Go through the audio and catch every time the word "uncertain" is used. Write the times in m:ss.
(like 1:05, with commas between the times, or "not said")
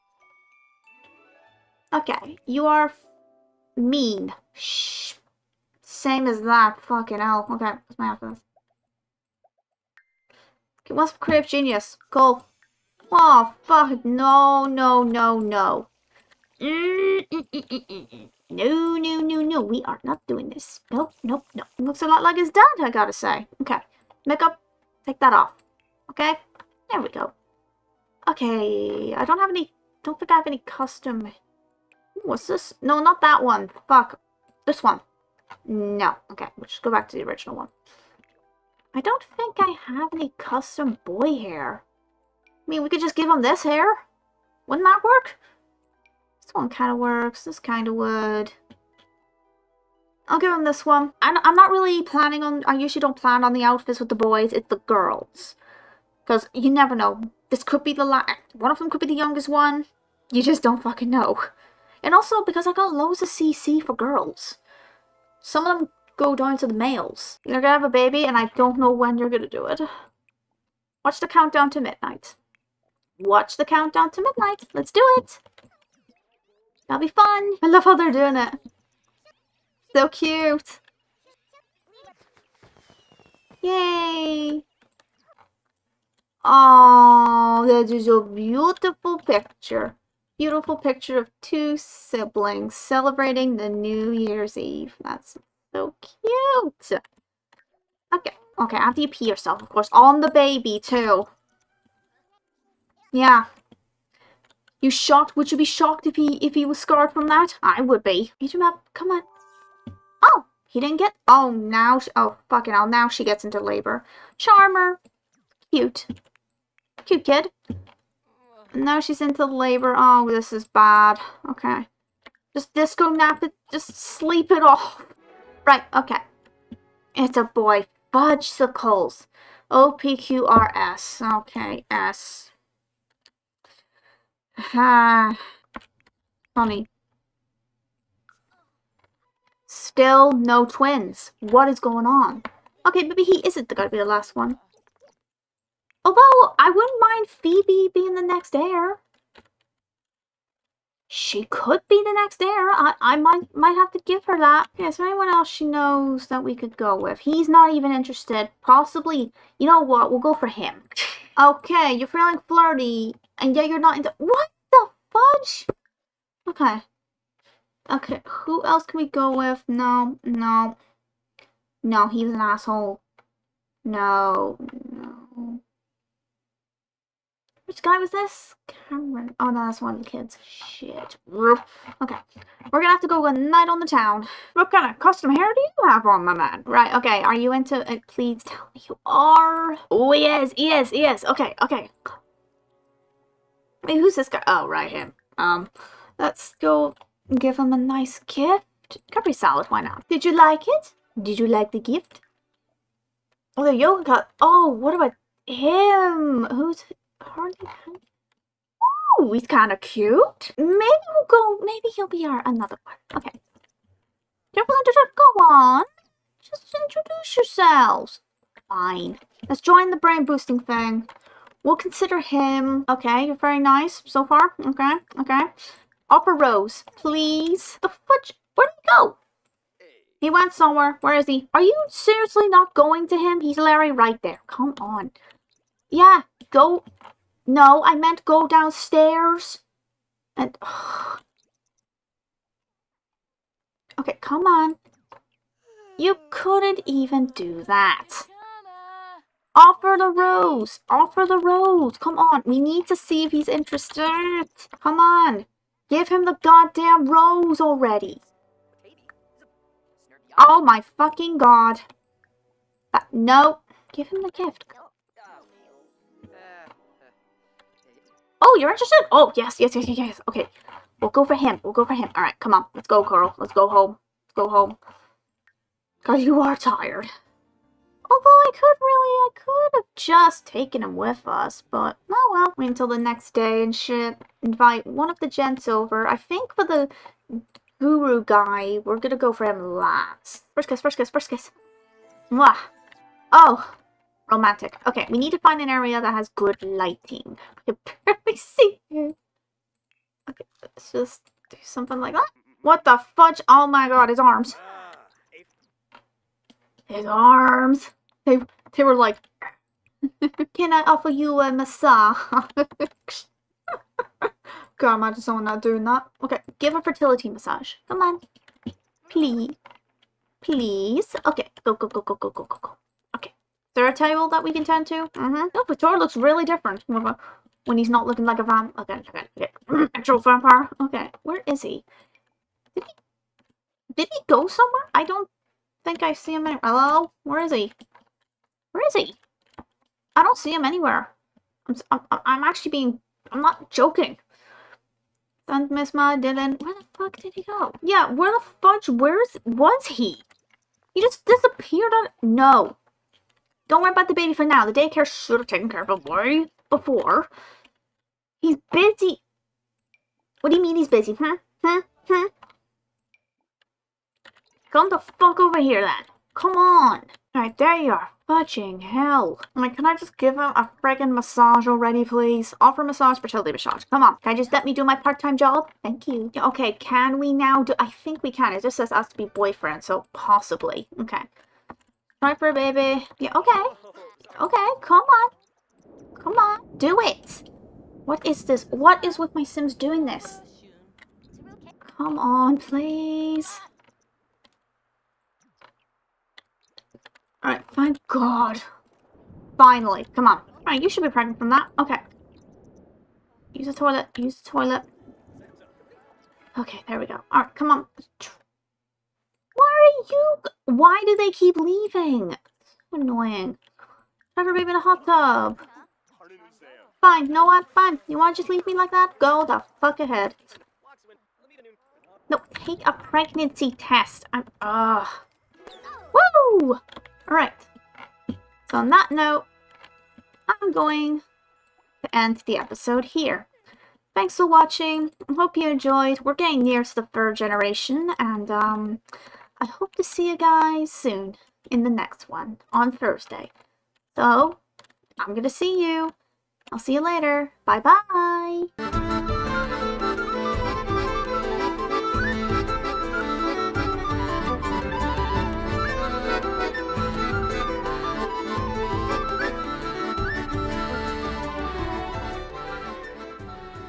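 not said.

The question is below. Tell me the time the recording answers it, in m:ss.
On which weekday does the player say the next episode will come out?
7:22.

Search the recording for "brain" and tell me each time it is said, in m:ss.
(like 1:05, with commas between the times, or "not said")
3:39.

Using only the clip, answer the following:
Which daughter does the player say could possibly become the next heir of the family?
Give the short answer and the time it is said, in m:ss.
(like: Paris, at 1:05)
Phoebe, at 2:27.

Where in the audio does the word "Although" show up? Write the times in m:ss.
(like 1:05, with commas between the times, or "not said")
2:26, 4:38.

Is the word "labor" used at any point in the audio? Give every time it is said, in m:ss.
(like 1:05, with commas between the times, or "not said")
1:53, 1:59.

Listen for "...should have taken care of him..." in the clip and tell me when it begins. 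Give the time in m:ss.
5:55.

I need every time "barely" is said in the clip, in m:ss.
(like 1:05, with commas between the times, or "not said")
4:58.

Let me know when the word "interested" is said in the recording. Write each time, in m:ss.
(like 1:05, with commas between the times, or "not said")
2:37, 4:13, 4:28.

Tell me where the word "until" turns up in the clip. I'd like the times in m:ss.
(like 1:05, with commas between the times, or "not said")
4:42.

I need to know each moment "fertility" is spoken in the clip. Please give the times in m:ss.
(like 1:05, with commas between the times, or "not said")
5:16, 6:13.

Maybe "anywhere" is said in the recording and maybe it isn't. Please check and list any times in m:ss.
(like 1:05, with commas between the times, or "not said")
5:36, 5:40.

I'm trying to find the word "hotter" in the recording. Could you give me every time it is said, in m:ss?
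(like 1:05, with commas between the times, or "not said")
not said.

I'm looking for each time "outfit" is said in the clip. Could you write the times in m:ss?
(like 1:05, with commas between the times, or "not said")
0:08, 0:53.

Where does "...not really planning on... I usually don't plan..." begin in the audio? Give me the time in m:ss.
0:51.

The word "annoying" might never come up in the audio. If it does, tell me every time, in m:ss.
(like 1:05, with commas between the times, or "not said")
6:53.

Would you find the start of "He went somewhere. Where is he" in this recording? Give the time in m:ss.
3:50.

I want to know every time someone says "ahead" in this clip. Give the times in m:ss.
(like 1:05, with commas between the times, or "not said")
7:00.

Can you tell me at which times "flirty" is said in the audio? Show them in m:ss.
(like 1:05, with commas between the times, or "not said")
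2:42.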